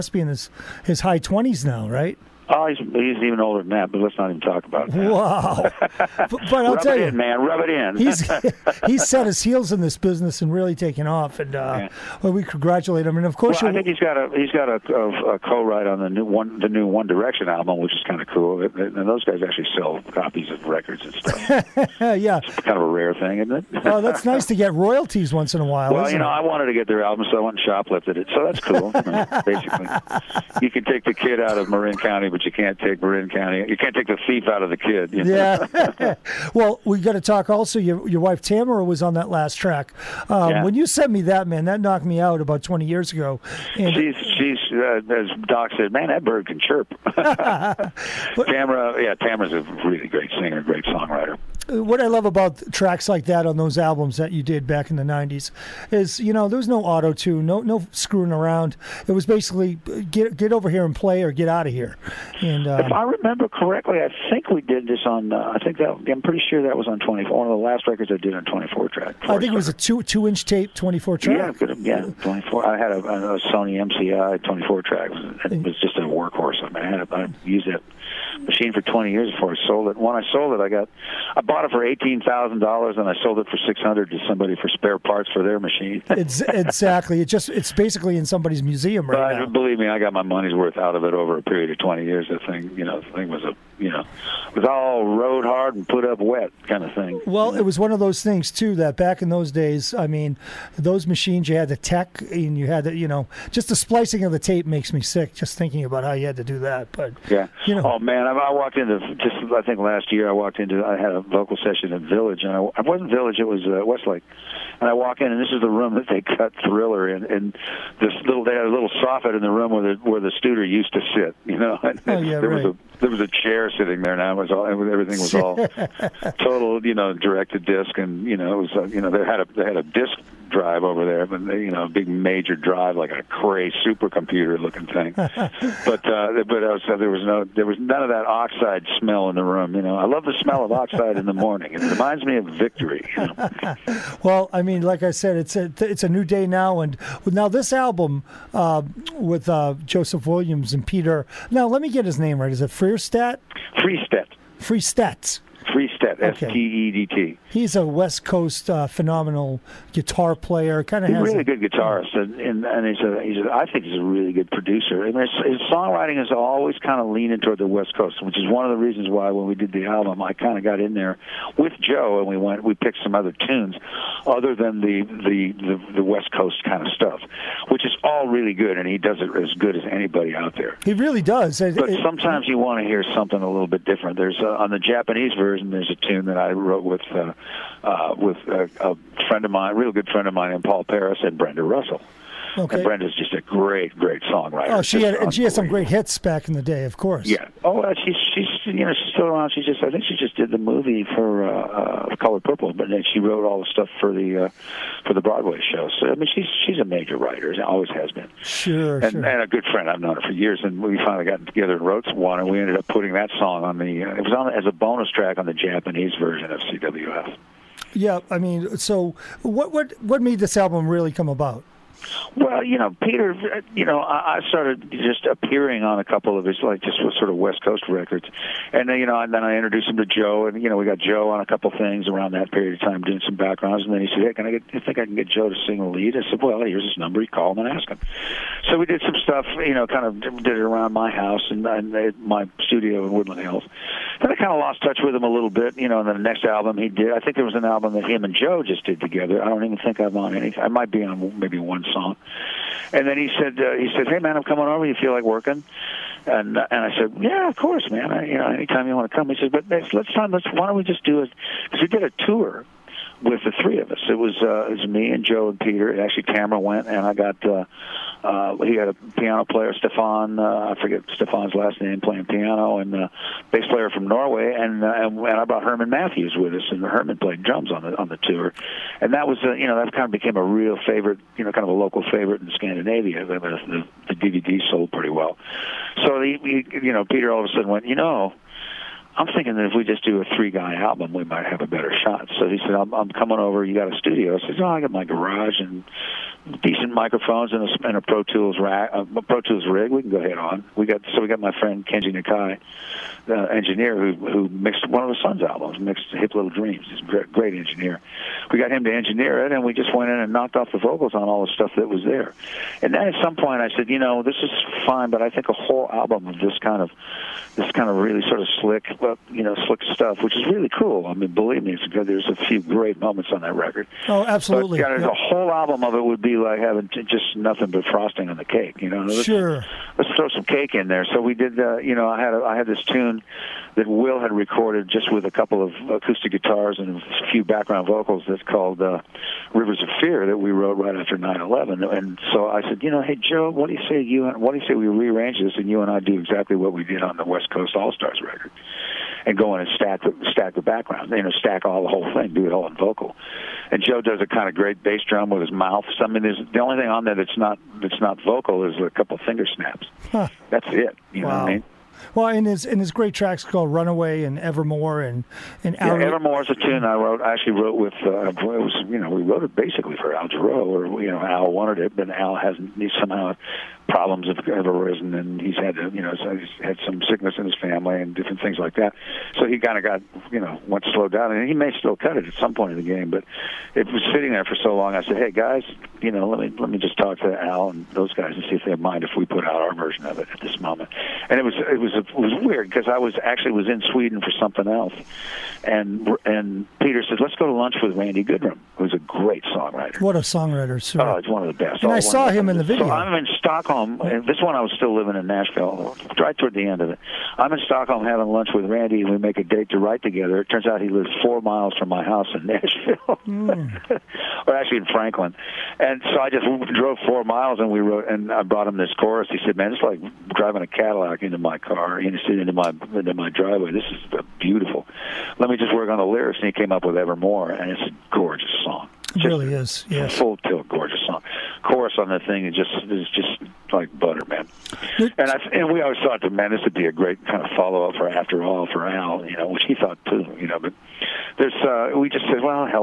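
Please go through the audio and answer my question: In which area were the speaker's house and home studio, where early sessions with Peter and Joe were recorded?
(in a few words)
Woodland Hills.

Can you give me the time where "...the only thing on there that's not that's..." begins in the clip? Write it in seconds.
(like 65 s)
356 s.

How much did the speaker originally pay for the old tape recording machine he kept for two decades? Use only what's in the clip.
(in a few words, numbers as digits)
$18,000.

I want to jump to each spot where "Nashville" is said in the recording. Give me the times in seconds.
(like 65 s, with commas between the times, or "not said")
405 s, 412 s.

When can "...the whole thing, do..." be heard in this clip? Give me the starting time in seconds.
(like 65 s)
351 s.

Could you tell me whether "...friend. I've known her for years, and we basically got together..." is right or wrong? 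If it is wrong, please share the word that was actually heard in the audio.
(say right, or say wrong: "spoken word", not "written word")
wrong: "finally", not "basically".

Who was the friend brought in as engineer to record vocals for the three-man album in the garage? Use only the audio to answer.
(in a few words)
Kenji Nakai.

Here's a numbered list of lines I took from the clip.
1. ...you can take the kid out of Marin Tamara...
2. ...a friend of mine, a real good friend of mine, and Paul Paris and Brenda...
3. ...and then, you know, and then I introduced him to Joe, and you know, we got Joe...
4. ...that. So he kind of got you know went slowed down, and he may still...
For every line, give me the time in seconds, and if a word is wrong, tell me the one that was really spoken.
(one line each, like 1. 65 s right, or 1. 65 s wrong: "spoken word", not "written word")
1. 30 s wrong: "County", not "Tamara"
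2. 188 s right
3. 228 s right
4. 378 s right.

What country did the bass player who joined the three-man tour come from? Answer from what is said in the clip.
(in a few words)
Norway.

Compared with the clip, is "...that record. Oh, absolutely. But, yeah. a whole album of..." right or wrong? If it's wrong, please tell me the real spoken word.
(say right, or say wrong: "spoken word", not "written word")
right.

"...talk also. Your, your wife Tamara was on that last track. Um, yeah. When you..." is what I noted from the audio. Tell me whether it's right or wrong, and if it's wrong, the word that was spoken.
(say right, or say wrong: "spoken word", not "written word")
right.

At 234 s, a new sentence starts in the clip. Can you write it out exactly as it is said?
I think I can get Joe to sing a lead." I said, "Well, here's his number.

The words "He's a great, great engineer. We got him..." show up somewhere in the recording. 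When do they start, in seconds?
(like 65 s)
306 s.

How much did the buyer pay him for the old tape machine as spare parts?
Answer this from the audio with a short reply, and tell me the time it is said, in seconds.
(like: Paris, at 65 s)
$600, at 83 s.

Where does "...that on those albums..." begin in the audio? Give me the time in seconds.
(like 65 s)
53 s.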